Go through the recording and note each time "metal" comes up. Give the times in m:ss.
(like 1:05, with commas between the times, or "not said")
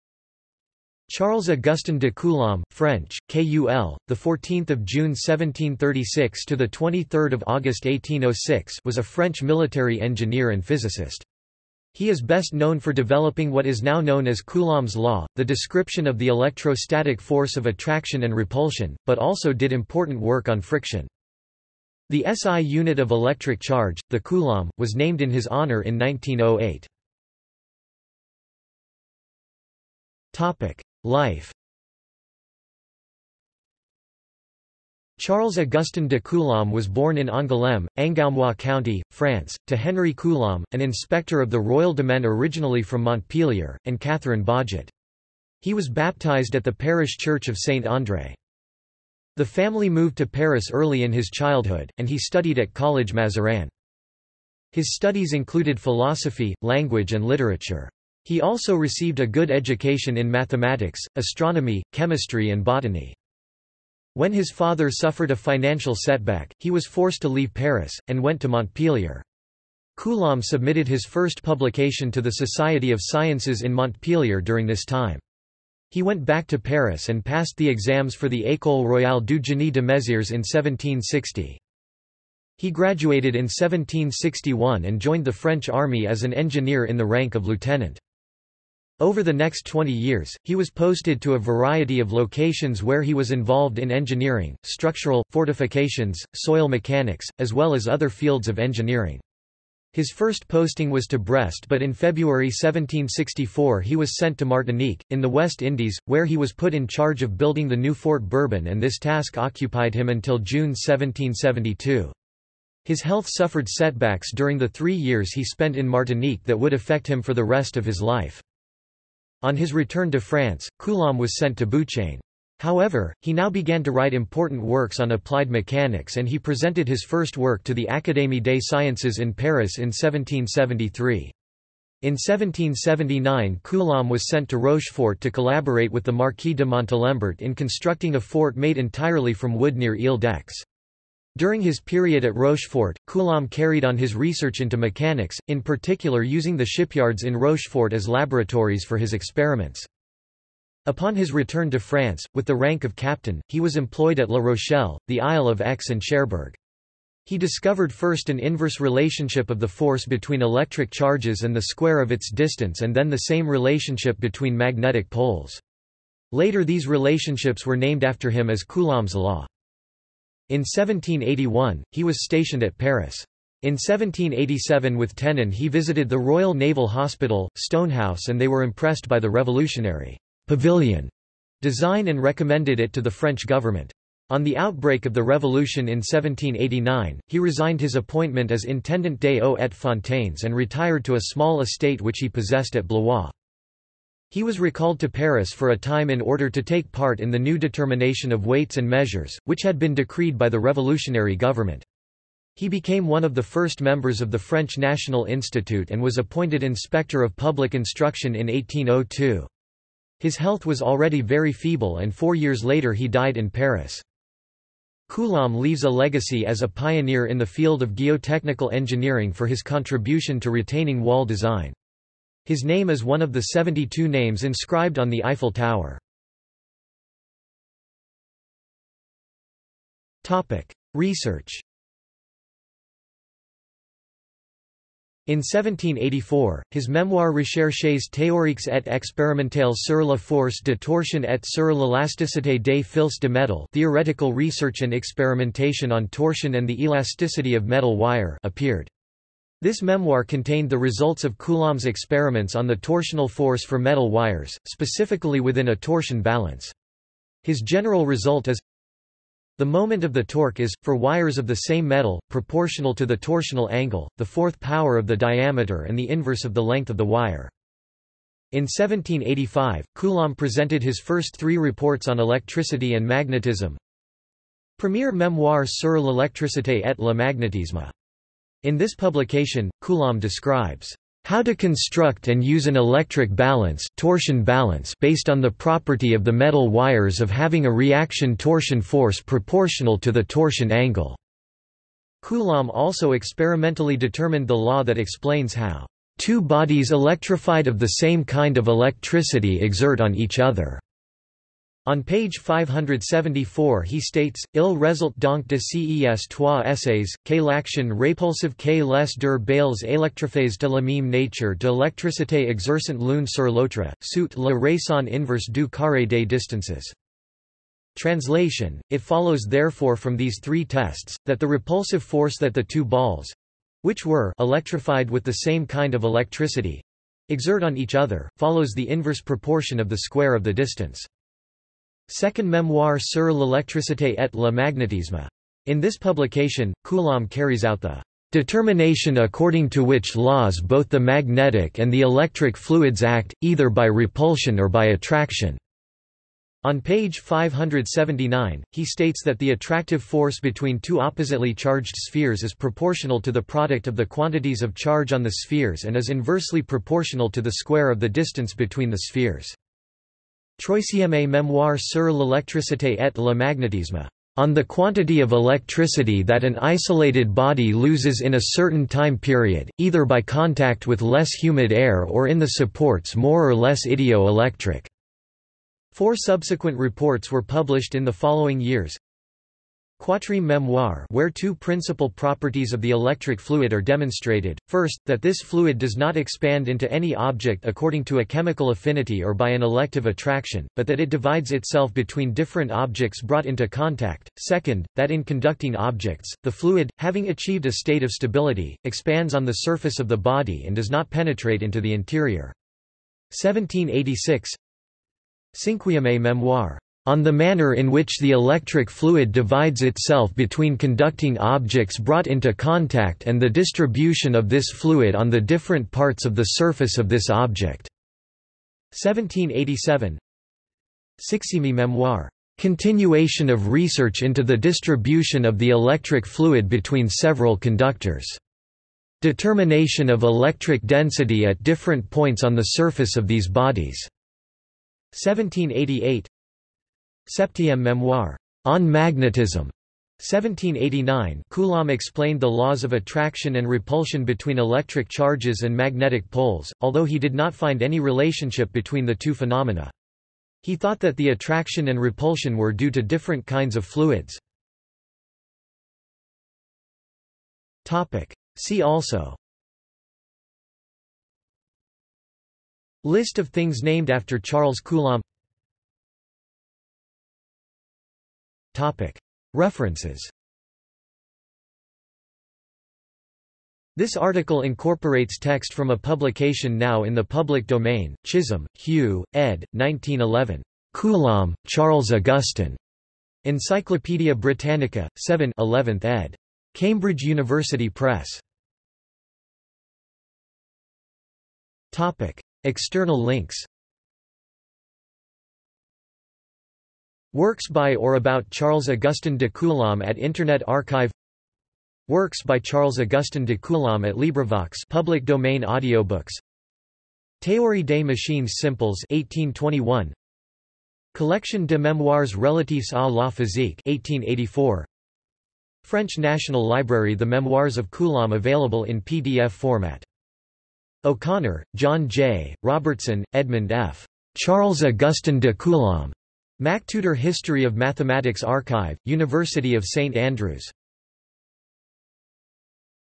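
4:07, 4:13, 4:21, 4:46.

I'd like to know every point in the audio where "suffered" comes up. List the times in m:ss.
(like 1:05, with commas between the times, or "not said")
1:04, 1:53.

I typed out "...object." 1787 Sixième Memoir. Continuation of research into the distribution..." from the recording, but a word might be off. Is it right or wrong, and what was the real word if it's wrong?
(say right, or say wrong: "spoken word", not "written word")
right.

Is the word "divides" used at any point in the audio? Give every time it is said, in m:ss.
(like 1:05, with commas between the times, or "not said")
6:31, 6:49.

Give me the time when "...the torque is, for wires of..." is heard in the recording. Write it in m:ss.
4:20.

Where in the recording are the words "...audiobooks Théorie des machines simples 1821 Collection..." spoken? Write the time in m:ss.
8:25.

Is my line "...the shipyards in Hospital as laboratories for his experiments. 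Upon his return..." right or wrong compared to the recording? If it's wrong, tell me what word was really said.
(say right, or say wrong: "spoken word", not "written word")
wrong: "Rochefort", not "Hospital".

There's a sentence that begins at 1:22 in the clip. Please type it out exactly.
He graduated in 1761 and joined the French army as an engineer in the rank of lieutenant.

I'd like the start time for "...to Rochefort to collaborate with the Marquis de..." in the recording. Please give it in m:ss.
2:14.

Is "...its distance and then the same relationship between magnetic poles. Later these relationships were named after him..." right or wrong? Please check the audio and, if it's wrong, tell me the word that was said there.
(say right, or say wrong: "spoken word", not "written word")
right.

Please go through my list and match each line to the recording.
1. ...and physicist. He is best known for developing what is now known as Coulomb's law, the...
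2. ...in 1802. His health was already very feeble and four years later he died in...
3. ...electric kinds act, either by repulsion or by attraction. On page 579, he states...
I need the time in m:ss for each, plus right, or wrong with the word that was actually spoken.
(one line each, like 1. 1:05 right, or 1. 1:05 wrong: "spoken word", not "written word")
1. 0:10 right
2. 3:28 right
3. 5:42 wrong: "fluids", not "kinds".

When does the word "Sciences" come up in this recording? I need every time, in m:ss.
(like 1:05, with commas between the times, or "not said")
1:13, 2:08.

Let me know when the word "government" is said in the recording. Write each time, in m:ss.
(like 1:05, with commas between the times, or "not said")
3:03, 3:21.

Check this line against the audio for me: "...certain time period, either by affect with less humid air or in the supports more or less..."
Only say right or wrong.
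wrong.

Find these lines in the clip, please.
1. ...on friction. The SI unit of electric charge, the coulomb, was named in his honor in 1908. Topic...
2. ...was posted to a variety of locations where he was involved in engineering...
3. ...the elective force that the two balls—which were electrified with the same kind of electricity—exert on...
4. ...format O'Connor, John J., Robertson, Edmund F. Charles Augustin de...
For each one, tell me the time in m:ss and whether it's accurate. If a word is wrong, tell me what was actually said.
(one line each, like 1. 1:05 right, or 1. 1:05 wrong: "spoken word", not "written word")
1. 0:20 right
2. 1:30 right
3. 5:21 wrong: "repulsive", not "elective"
4. 8:39 right.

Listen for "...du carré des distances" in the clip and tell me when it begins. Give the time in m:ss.
5:15.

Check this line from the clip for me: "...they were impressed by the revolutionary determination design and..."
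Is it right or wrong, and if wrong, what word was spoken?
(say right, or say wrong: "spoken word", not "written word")
wrong: "pavilion", not "determination".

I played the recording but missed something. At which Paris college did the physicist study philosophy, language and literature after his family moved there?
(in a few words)
College Mazarin.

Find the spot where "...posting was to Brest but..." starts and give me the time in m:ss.
1:40.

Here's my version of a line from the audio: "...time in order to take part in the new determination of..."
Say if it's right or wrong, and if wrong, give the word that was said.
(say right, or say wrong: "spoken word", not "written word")
right.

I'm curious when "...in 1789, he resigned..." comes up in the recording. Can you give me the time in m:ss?
3:05.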